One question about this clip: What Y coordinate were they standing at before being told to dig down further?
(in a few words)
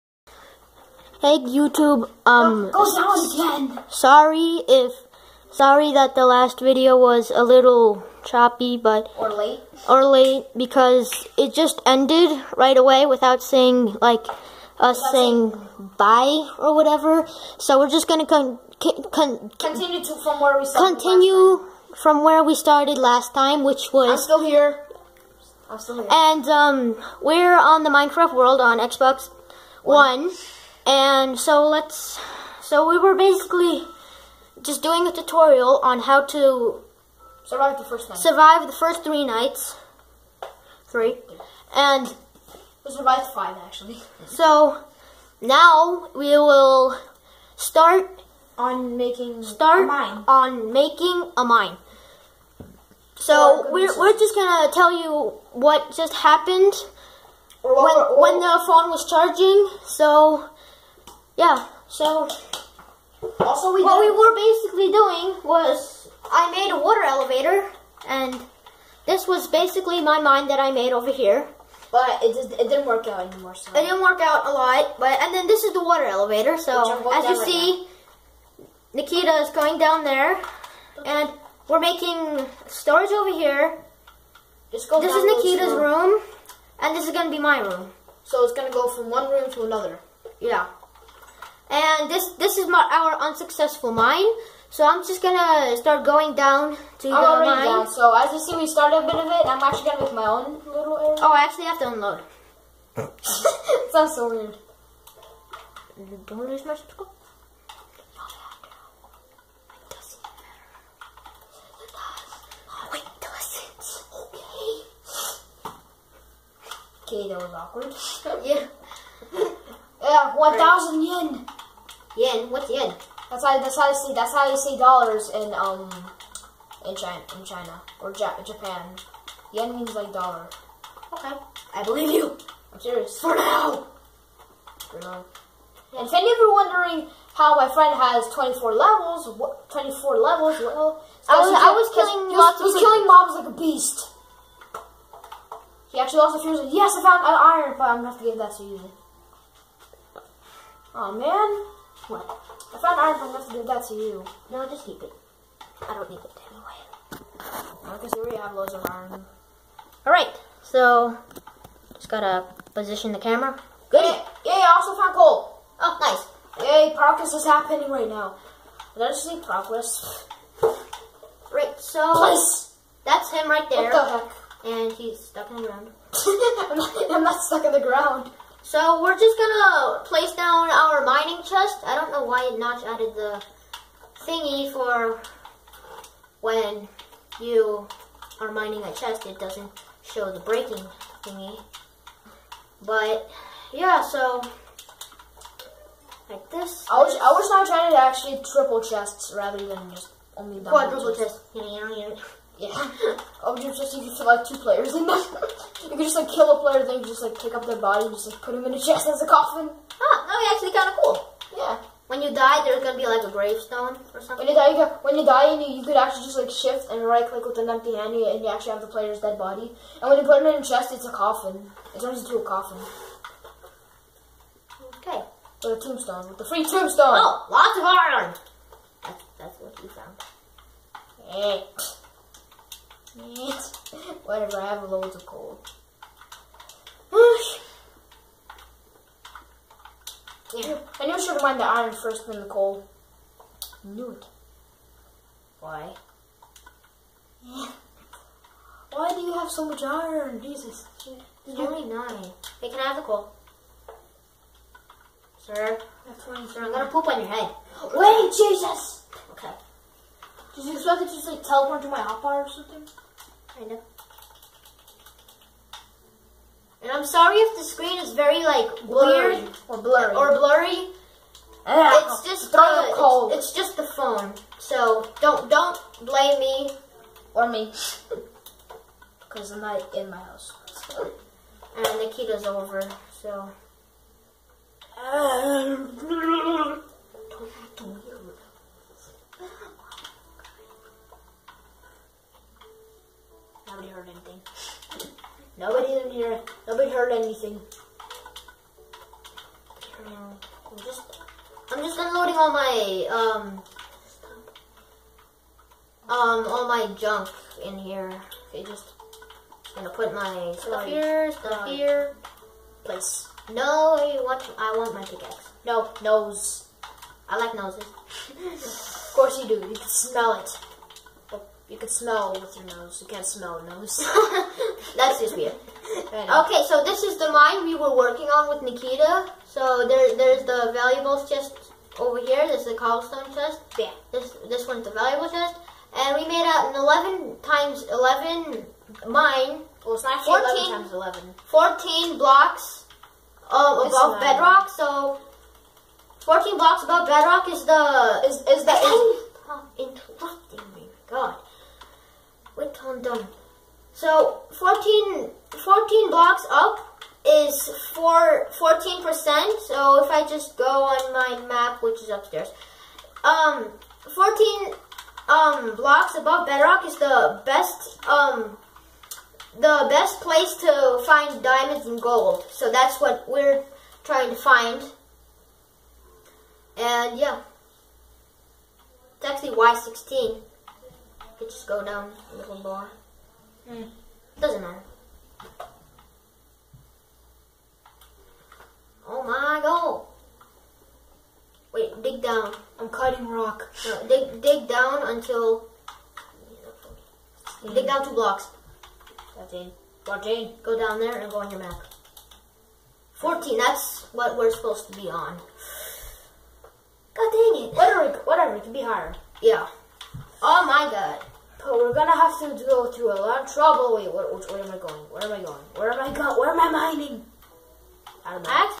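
Y16.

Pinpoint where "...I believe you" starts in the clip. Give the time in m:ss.
2:11.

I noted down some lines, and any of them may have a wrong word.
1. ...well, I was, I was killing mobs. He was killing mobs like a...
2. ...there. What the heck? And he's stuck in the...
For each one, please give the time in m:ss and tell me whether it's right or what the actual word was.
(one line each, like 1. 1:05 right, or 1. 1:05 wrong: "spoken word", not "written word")
1. 2:20 right
2. 2:53 right.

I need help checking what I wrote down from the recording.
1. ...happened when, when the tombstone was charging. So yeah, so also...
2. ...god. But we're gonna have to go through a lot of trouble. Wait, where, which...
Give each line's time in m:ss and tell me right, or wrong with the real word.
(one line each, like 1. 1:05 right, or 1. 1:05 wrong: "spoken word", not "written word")
1. 0:56 wrong: "phone", not "tombstone"
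2. 6:50 right.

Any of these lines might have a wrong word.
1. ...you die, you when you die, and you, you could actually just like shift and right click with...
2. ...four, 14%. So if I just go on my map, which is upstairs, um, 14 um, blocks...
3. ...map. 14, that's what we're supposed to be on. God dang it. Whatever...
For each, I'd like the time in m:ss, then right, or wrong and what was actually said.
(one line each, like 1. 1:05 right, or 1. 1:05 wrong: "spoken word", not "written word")
1. 3:34 right
2. 5:57 right
3. 6:41 right.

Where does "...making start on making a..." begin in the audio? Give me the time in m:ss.
0:48.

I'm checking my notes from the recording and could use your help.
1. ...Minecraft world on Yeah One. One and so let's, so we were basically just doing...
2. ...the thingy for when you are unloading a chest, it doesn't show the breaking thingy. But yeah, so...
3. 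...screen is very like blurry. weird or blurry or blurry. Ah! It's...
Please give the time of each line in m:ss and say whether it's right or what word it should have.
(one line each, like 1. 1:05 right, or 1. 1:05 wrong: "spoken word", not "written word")
1. 0:27 wrong: "Xbox", not "Yeah"
2. 3:03 wrong: "mining", not "unloading"
3. 4:27 right.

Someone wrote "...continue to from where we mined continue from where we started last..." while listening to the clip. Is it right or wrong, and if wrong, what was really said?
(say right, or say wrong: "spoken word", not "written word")
wrong: "started", not "mined".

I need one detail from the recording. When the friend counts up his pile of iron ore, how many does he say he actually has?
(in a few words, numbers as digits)
9.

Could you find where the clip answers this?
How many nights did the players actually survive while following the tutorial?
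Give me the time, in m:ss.
0:42.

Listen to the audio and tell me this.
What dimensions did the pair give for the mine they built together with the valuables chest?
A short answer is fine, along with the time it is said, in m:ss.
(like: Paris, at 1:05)
11 times 11, at 5:36.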